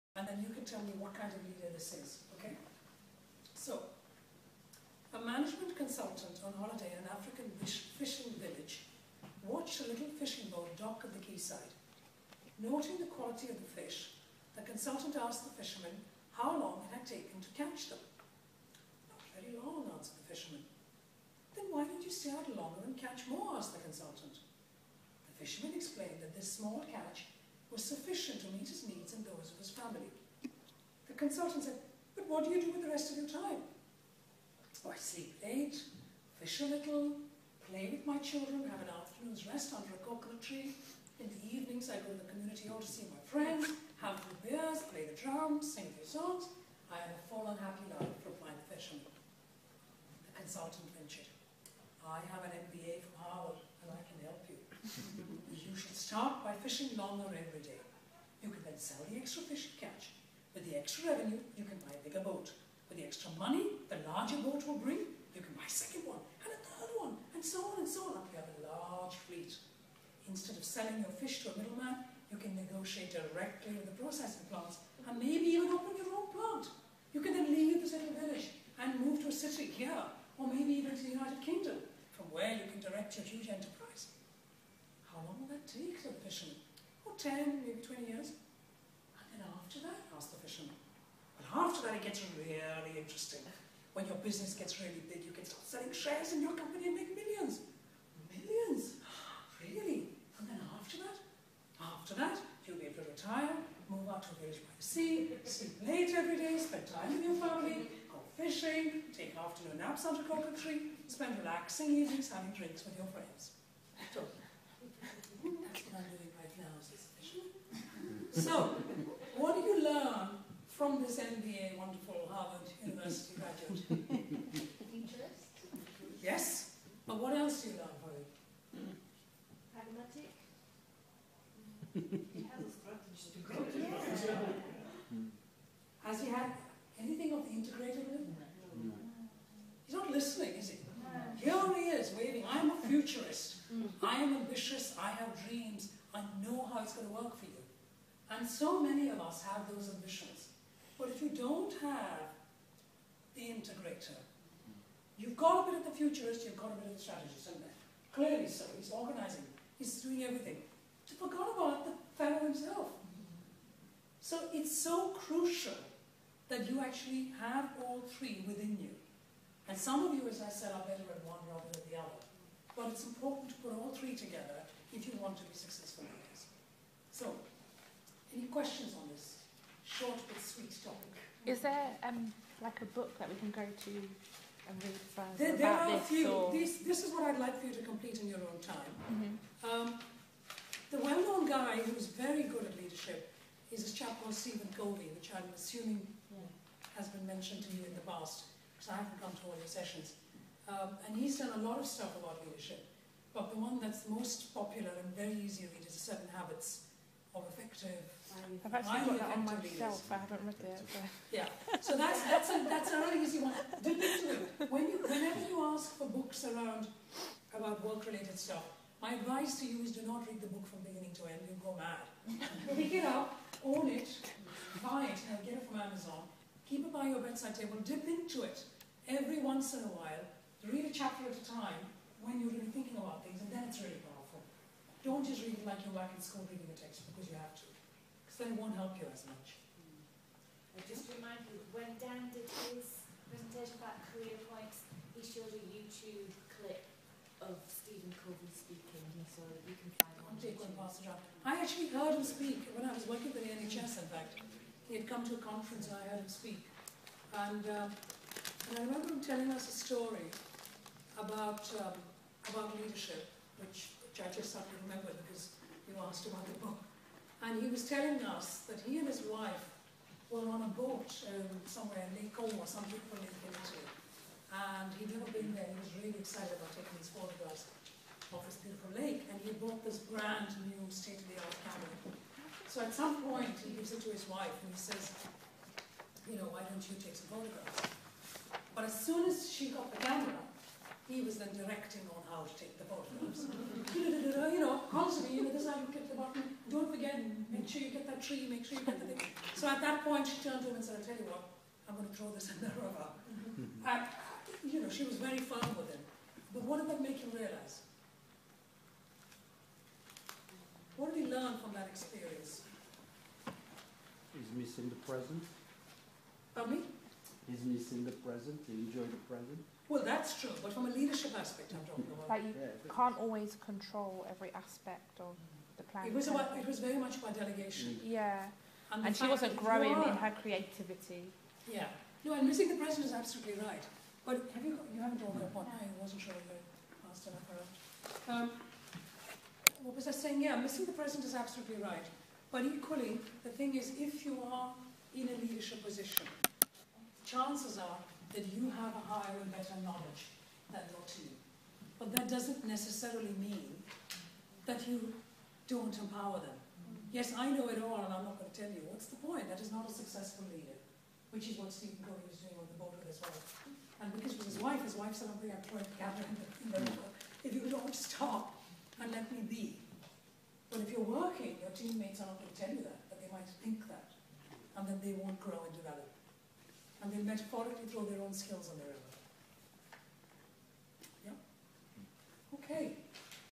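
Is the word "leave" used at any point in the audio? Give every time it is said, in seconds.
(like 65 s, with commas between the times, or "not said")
77 s.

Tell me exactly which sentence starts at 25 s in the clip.
The fisherman explained that this small catch was sufficient to meet his needs and those of his family.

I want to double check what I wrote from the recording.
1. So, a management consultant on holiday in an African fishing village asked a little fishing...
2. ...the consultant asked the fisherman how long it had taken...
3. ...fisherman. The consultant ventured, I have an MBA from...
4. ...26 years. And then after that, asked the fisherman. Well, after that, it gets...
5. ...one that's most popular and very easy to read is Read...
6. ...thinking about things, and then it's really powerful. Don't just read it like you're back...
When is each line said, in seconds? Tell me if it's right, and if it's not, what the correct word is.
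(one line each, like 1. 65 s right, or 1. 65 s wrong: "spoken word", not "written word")
1. 3 s wrong: "watched", not "asked"
2. 14 s right
3. 48 s right
4. 87 s wrong: "20", not "26"
5. 203 s wrong: "The", not "Read"
6. 232 s right.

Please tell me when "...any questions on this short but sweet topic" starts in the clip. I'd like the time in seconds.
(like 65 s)
178 s.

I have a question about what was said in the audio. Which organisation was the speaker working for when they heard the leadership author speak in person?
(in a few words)
The NHS.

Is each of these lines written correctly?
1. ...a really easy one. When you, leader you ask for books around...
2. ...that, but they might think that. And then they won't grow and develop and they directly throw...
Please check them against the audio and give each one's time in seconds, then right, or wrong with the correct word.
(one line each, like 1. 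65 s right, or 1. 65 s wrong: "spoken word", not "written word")
1. 212 s wrong: "whenever", not "leader"
2. 372 s wrong: "metaphorically", not "directly".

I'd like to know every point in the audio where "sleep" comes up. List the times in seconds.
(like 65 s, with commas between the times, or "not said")
34 s, 105 s.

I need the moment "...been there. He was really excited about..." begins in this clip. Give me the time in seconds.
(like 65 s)
275 s.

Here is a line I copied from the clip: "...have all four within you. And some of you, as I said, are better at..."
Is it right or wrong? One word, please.
wrong.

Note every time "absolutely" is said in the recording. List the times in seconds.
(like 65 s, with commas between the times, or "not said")
333 s, 341 s.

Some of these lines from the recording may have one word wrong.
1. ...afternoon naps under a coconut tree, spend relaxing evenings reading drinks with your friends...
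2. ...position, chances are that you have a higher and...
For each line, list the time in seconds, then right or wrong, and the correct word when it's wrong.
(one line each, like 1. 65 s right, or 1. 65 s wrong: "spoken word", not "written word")
1. 109 s wrong: "having", not "reading"
2. 345 s right.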